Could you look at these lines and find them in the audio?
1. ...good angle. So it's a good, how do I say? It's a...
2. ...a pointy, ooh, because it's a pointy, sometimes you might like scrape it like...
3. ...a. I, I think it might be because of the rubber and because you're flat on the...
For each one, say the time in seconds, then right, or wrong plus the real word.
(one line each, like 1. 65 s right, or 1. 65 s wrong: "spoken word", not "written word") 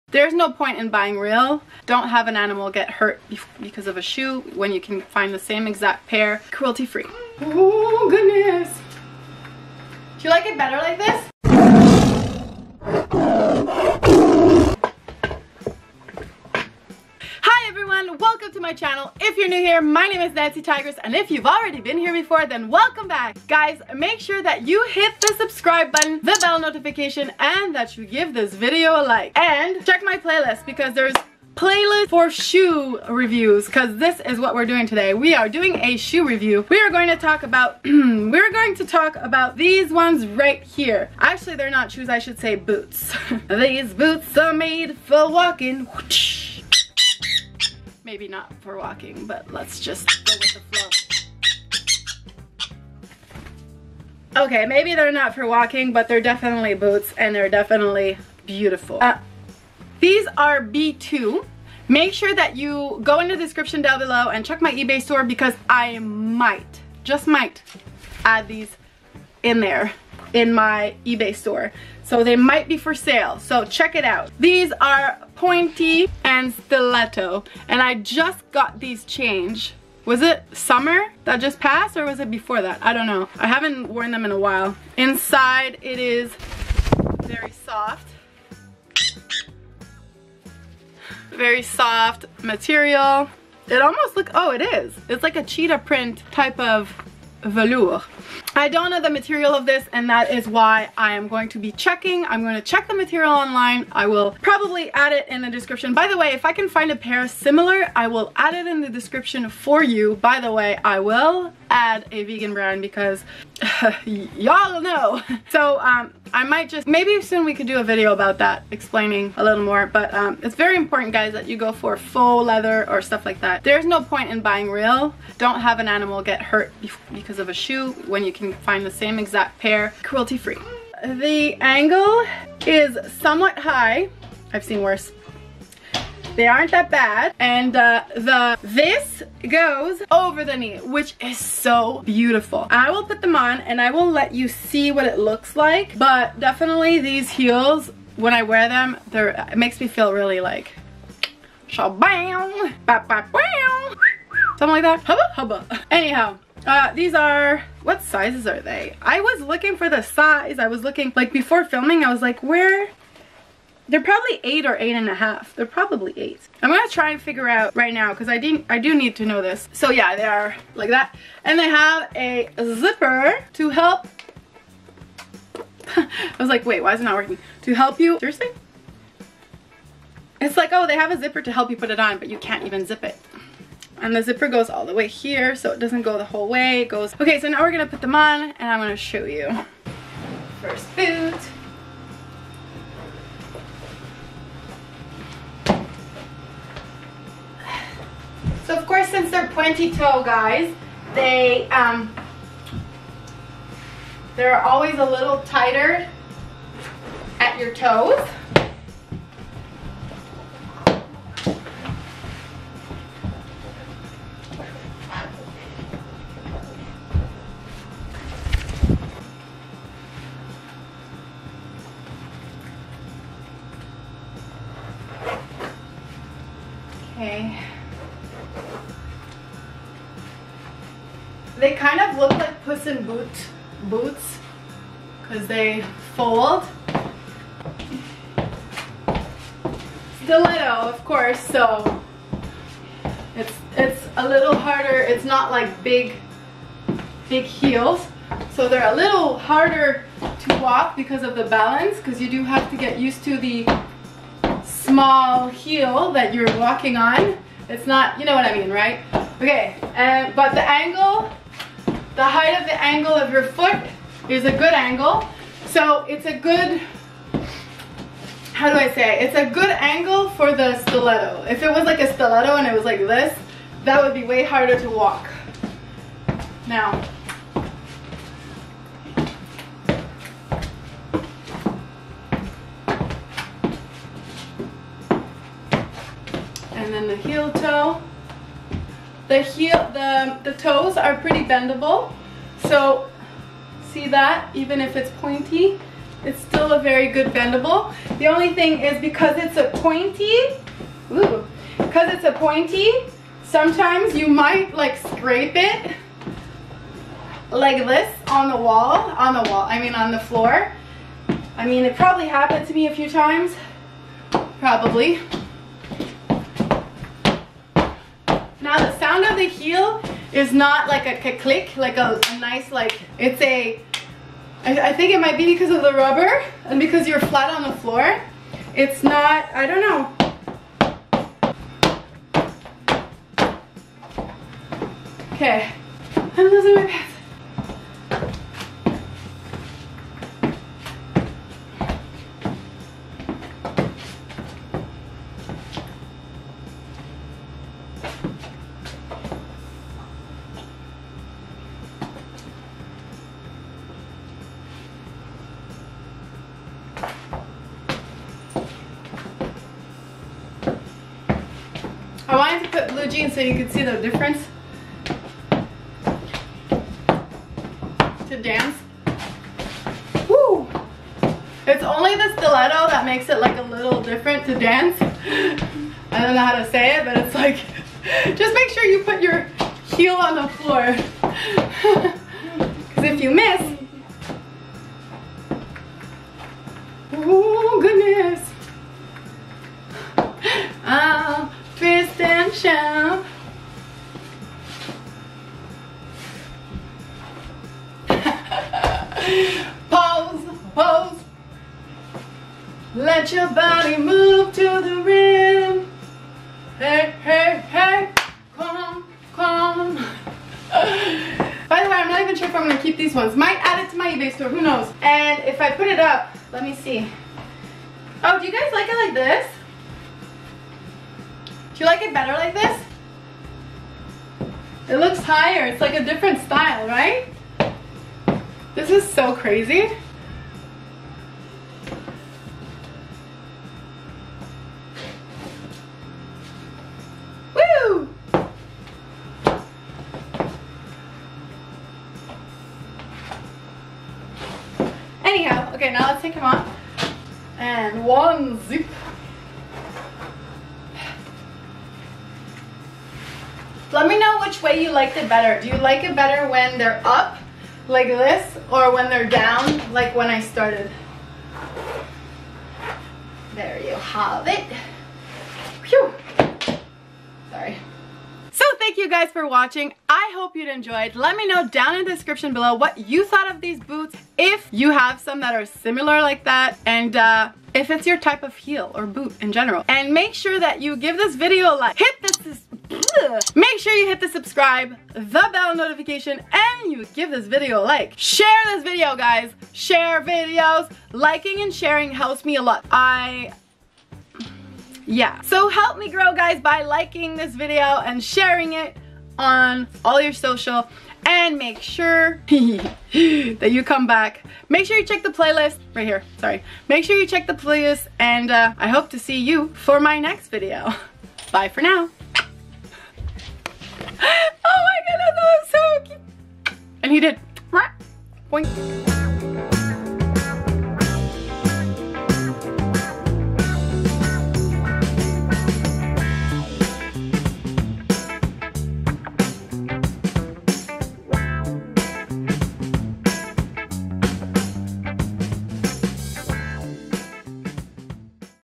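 1. 264 s right
2. 299 s right
3. 323 s right.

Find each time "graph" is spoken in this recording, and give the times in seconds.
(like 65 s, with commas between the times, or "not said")
not said.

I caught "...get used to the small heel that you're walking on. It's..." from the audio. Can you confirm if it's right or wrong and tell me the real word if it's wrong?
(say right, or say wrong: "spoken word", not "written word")
right.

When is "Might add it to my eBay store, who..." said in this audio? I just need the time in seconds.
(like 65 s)
413 s.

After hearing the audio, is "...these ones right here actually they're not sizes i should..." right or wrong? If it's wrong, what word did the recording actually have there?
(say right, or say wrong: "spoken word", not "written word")
wrong: "shoes", not "sizes".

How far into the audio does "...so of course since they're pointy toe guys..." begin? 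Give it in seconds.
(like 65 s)
198 s.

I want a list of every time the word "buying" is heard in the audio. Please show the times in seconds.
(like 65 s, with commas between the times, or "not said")
0 s, 124 s.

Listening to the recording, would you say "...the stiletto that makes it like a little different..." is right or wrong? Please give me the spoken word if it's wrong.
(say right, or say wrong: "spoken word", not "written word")
right.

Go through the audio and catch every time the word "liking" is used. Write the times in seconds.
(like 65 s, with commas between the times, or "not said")
491 s, 496 s.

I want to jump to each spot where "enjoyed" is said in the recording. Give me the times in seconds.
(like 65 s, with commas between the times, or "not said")
470 s.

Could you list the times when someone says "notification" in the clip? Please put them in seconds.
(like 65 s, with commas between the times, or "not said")
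26 s, 485 s.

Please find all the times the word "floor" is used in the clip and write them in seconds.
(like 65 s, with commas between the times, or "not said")
310 s, 327 s, 380 s.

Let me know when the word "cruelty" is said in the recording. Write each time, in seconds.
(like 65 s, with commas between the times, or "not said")
6 s, 130 s.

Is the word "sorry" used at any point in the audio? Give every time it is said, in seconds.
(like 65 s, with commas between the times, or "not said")
467 s, 506 s.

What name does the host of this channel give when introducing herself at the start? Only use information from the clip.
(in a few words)
Nancy Tigers.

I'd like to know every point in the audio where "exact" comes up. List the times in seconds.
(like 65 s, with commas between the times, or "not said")
5 s, 129 s.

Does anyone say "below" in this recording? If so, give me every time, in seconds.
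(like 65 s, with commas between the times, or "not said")
63 s, 472 s.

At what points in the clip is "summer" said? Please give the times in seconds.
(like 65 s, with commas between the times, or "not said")
80 s.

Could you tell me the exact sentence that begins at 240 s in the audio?
Stiletto, of course, so it's, it's a little harder.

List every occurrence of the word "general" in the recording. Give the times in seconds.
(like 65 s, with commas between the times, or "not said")
479 s.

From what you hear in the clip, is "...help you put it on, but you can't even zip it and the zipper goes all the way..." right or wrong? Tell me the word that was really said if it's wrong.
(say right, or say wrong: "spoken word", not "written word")
right.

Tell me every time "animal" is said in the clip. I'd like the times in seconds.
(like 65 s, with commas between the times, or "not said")
2 s, 125 s.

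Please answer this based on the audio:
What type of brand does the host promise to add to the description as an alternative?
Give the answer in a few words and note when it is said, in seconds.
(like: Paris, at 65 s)
A vegan brand, at 112 s.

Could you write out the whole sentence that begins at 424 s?
It looks higher, it's like a different style, right?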